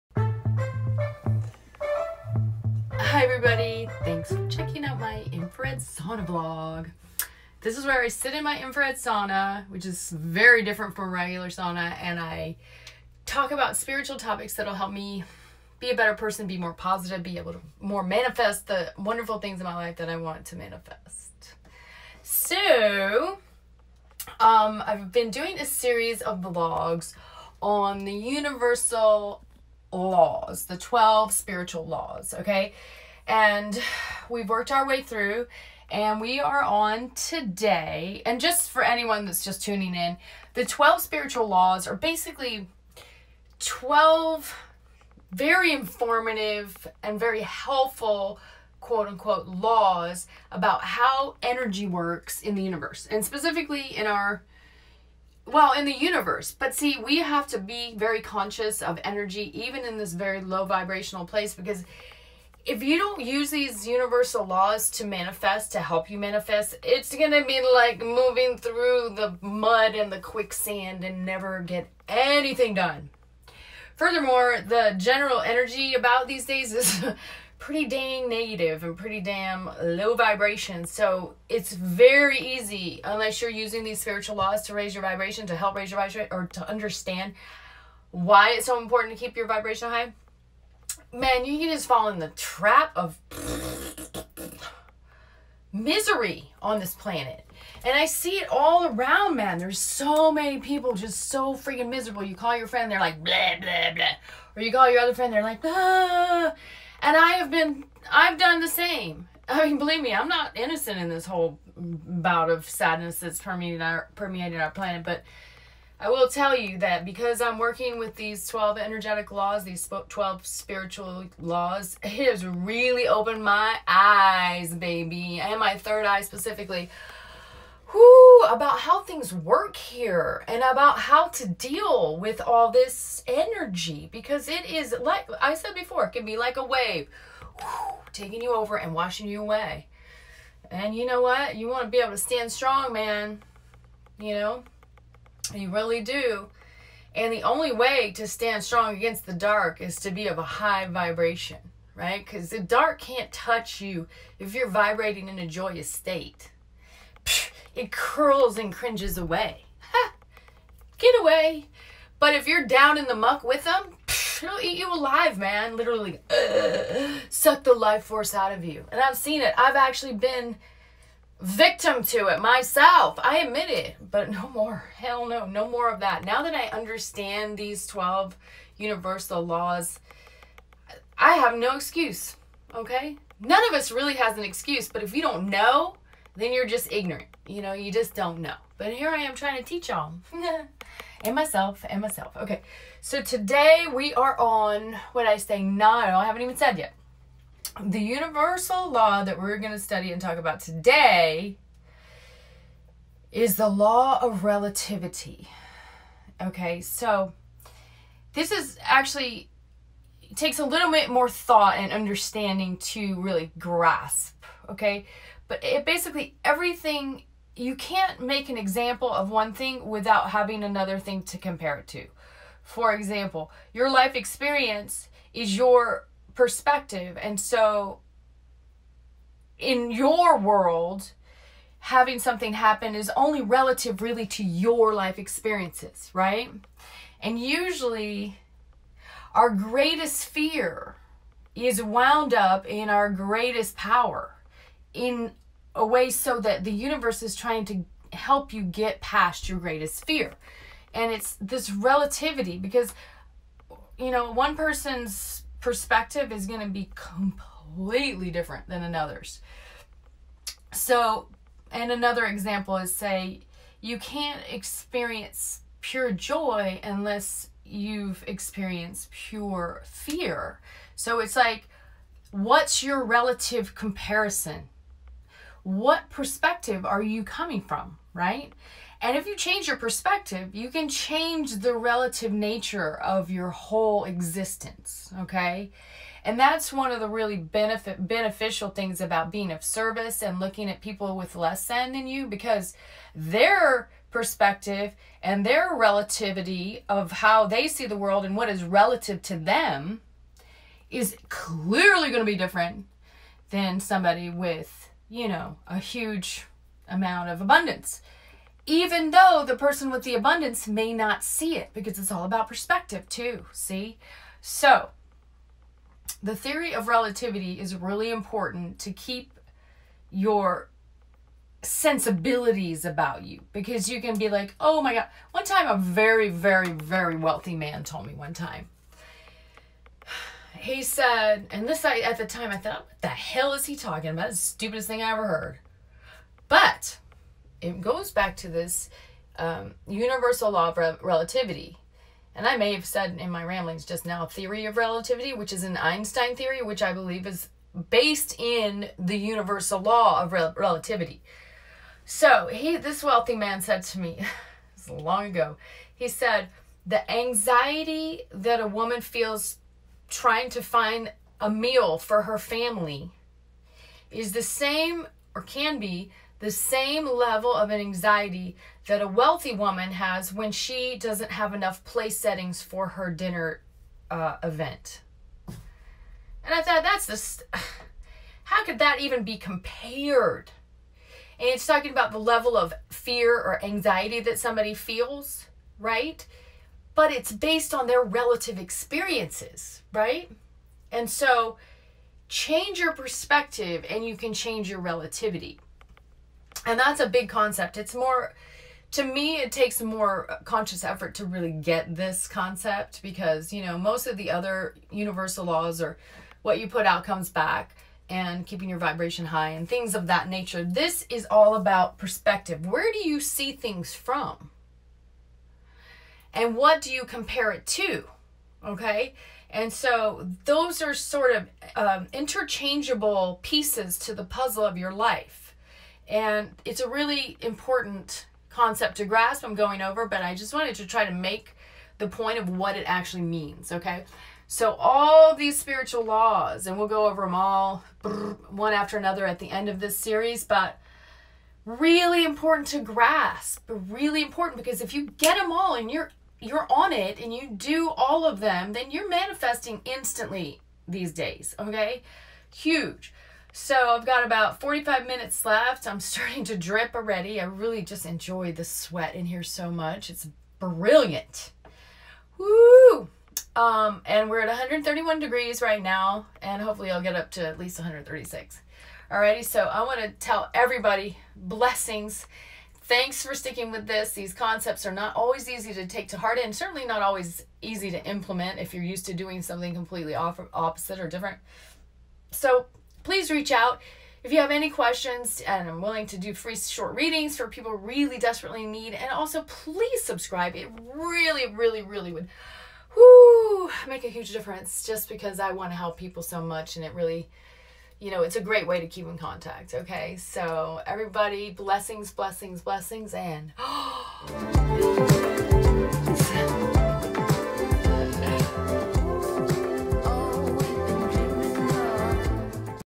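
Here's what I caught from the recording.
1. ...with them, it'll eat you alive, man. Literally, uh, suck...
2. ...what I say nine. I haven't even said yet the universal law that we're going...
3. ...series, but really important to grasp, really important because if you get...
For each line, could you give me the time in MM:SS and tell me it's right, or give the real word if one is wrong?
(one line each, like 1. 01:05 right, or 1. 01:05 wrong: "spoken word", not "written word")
1. 02:43 right
2. 03:15 right
3. 07:19 right.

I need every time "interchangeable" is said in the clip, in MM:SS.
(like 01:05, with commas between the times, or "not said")
07:02.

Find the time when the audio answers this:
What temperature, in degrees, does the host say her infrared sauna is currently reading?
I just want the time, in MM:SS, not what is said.
07:44.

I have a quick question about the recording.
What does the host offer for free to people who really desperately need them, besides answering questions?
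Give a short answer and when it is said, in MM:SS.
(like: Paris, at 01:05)
short readings, at 08:06.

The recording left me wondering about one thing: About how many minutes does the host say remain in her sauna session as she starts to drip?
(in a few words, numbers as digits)
45.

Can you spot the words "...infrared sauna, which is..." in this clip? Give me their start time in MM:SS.
00:08.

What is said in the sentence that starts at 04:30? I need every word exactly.
So it's like, what's your relative comparison?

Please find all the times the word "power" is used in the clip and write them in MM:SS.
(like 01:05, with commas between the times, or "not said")
04:03.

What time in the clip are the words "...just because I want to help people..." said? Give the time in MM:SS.
08:14.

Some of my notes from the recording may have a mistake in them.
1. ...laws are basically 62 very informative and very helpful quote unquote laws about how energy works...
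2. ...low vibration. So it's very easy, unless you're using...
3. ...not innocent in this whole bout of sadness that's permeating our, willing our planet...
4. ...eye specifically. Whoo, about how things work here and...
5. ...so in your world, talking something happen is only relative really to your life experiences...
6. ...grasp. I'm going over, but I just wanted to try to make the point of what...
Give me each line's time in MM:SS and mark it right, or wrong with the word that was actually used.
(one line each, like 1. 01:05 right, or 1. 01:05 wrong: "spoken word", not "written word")
1. 00:41 wrong: "12", not "62"
2. 01:19 right
3. 01:50 wrong: "permeating", not "willing"
4. 02:06 right
5. 03:47 wrong: "having", not "talking"
6. 07:09 right.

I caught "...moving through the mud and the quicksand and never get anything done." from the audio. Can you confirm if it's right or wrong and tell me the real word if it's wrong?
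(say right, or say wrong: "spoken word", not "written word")
right.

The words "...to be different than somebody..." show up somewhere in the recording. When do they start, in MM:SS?
05:02.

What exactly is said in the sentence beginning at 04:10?
And it's this relativity because, you know, one person's perspective is going to be completely different than another's.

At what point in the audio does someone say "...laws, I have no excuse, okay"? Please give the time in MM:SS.
02:59.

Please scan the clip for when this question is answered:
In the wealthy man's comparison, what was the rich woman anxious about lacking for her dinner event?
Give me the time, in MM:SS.
06:11.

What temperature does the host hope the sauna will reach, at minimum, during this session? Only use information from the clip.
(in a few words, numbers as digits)
136.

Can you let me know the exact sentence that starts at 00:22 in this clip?
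So, um, I've been doing a series of vlogs on the universal laws, the 12 spiritual laws, okay?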